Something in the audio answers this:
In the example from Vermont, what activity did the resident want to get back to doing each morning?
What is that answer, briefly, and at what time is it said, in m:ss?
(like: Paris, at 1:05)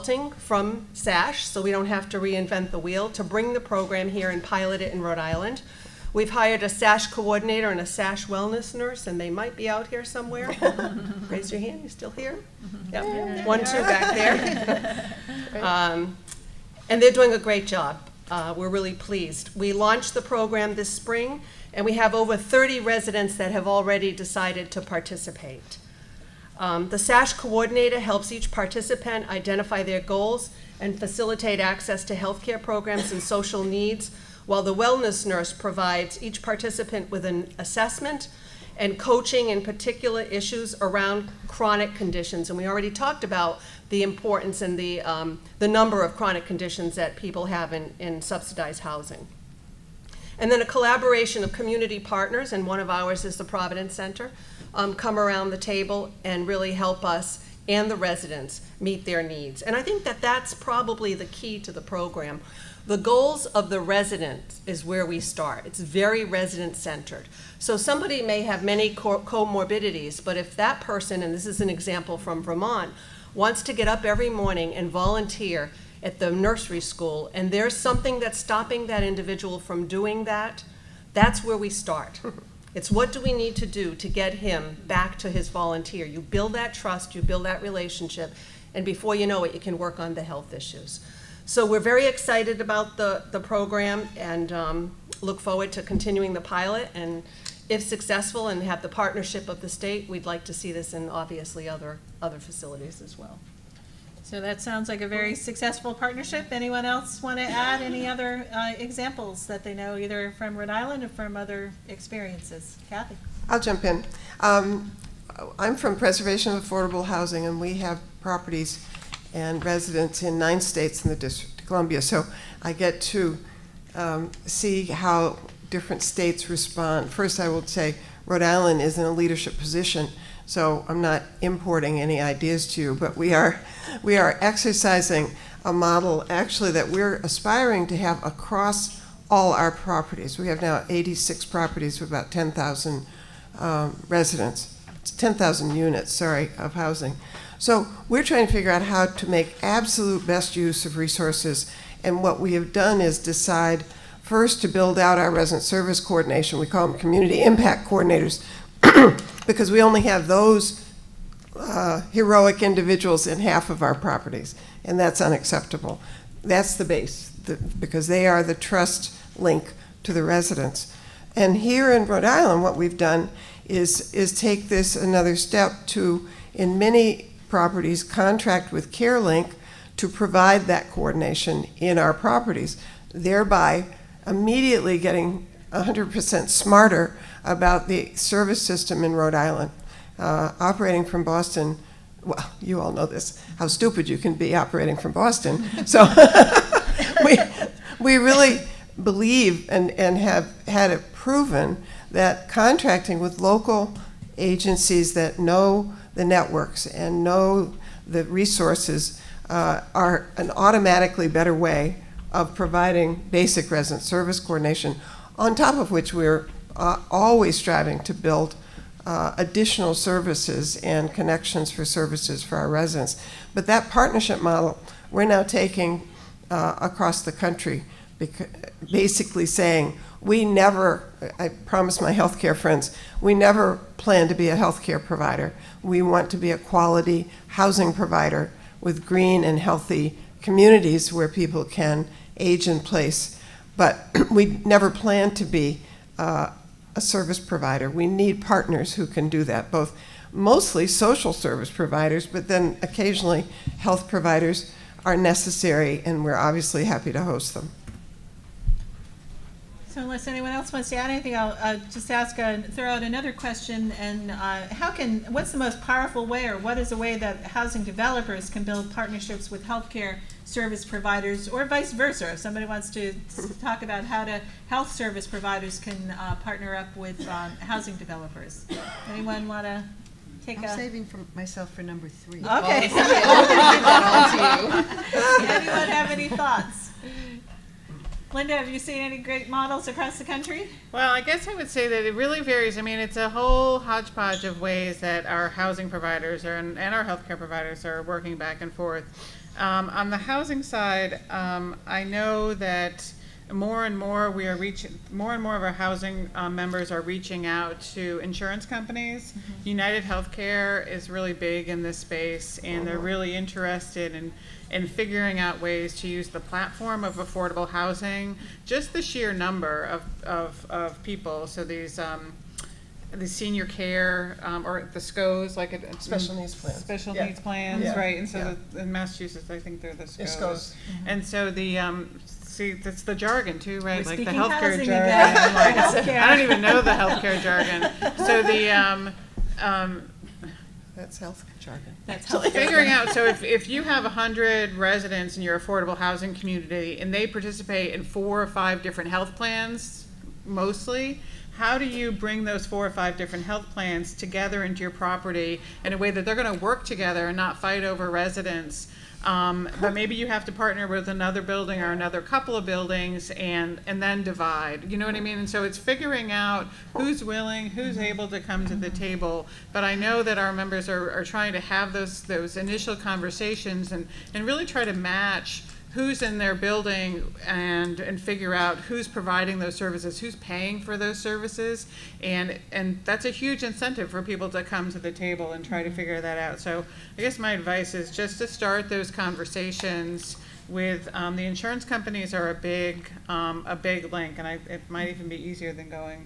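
volunteer at the nursery school, at 1:14.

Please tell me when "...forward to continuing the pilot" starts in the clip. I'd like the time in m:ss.
1:35.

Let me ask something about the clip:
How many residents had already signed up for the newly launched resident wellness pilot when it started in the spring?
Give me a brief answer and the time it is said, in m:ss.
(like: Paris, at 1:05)
over 30, at 0:22.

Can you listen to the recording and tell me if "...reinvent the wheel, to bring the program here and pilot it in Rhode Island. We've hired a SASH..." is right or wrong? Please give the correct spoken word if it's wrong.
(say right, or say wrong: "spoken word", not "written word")
right.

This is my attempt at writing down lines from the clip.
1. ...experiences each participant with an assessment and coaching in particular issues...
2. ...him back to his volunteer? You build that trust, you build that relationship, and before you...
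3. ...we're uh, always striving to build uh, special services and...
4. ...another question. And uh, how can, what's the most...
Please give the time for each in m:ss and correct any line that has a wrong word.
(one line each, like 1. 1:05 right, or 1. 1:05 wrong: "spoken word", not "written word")
1. 0:35 wrong: "provides", not "experiences"
2. 1:24 right
3. 3:36 wrong: "additional", not "special"
4. 4:23 right.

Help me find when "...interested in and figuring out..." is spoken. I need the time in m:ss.
5:13.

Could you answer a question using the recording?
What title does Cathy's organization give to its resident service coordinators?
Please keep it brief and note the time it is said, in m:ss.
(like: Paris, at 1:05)
community impact coordinators, at 2:36.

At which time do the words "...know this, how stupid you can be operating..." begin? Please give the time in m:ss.
3:12.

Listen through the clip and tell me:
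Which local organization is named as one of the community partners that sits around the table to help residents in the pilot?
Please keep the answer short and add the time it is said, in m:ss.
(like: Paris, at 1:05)
Providence Center, at 0:53.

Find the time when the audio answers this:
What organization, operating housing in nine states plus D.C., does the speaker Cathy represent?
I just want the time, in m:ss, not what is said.
1:55.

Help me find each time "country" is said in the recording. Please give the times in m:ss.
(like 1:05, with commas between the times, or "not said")
3:47, 4:50.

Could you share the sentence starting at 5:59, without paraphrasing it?
Um, but maybe you have to partner with another building or another couple of buildings and, and then divide.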